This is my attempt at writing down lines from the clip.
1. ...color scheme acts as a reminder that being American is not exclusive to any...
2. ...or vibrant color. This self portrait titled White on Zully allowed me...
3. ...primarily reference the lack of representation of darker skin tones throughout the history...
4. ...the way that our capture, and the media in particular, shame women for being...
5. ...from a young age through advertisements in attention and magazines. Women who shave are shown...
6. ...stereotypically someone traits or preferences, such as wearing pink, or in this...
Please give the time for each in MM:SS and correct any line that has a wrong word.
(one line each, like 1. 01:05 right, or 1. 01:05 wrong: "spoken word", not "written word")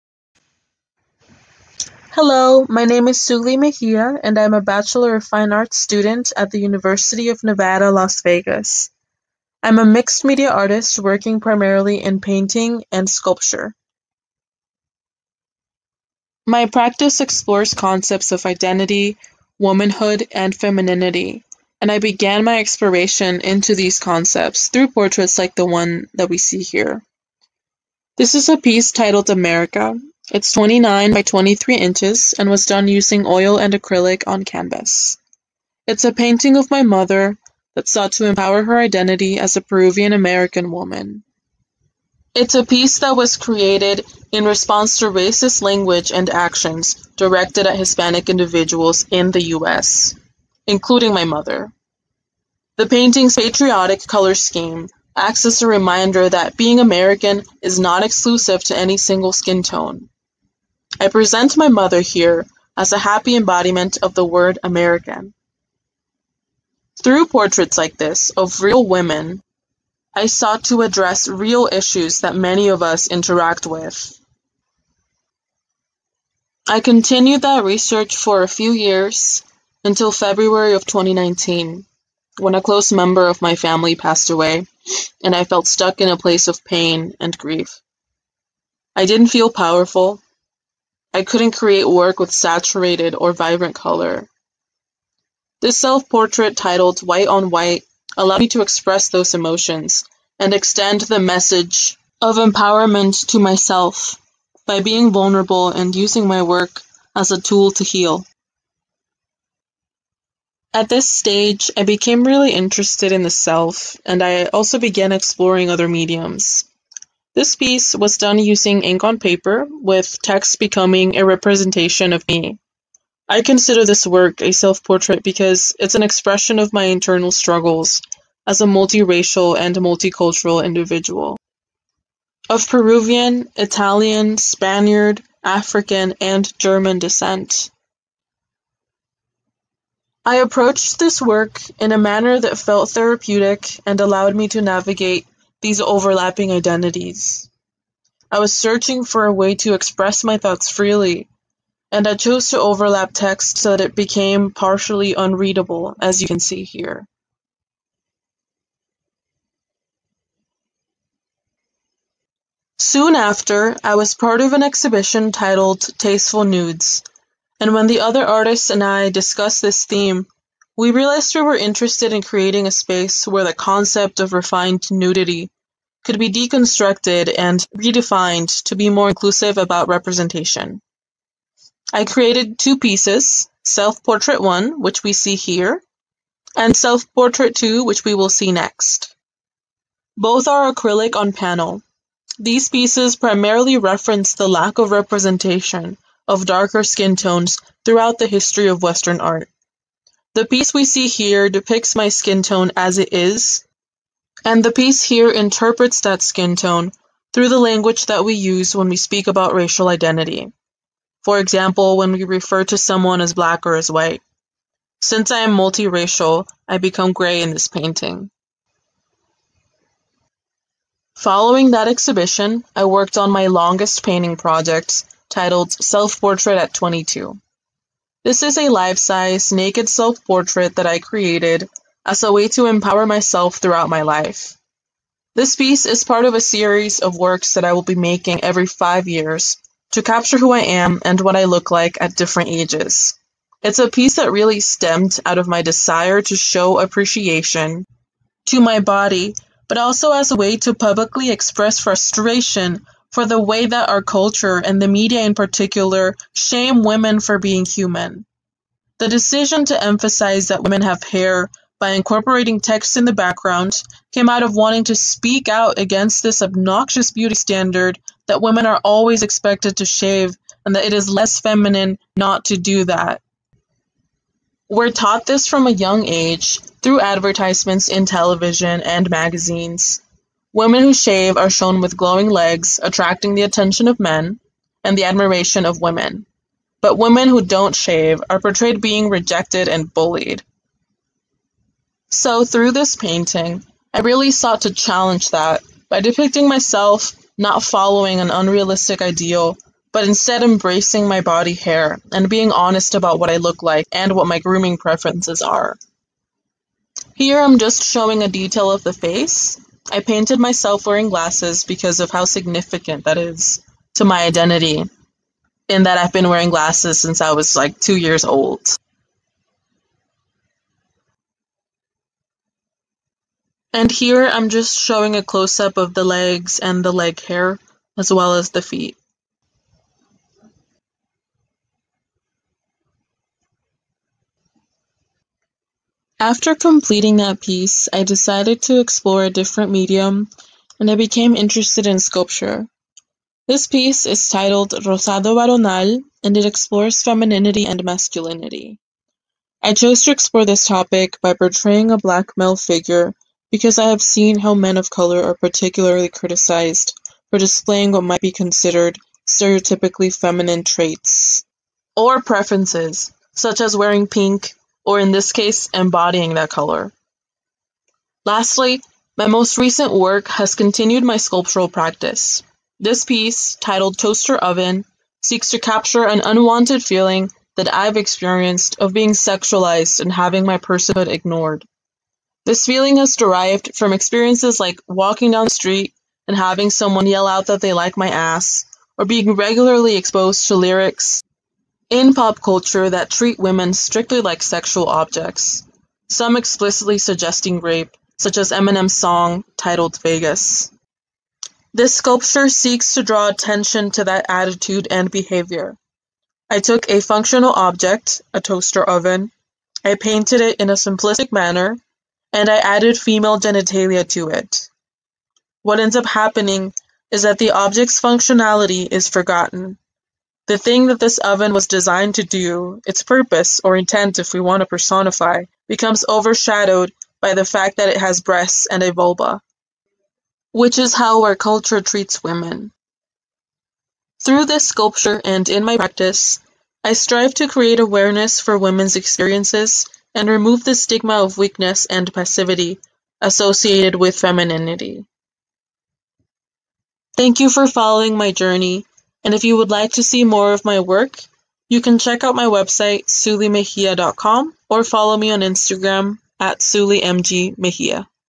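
1. 00:54 right
2. 01:33 wrong: "White", not "Zully"
3. 03:13 right
4. 04:13 wrong: "culture", not "capture"
5. 04:35 wrong: "television", not "attention"
6. 05:59 wrong: "feminine", not "someone".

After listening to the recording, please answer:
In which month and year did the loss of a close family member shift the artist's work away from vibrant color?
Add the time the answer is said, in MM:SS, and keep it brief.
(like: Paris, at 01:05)
February 2019, at 01:20.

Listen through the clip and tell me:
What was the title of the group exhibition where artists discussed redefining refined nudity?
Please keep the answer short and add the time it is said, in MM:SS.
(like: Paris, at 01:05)
Tasteful Nudes, at 02:45.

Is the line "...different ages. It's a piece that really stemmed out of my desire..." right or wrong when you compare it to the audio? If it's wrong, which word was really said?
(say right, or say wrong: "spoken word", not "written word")
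right.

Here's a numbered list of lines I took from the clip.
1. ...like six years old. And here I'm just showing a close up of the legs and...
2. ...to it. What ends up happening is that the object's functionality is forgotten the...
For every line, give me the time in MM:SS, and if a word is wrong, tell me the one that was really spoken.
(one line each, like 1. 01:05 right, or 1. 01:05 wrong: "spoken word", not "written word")
1. 05:17 wrong: "two", not "six"
2. 06:54 right.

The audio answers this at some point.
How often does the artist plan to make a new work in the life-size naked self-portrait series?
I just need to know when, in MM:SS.
03:58.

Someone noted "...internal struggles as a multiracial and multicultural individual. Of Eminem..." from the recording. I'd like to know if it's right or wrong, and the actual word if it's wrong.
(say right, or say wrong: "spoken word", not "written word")
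wrong: "Peruvian", not "Eminem".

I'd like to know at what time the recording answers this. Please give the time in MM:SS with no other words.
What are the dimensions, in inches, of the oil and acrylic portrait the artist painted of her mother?
00:30.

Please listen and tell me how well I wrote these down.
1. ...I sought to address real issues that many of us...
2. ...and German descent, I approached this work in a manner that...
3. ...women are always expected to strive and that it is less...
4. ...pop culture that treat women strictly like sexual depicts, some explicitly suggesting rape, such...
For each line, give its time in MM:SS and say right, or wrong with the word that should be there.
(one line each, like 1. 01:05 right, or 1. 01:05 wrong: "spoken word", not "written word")
1. 01:10 right
2. 02:16 right
3. 04:28 wrong: "shave", not "strive"
4. 06:32 wrong: "objects", not "depicts".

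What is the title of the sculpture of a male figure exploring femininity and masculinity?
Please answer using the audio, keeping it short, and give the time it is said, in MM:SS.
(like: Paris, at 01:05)
Rosado Varonil, at 05:44.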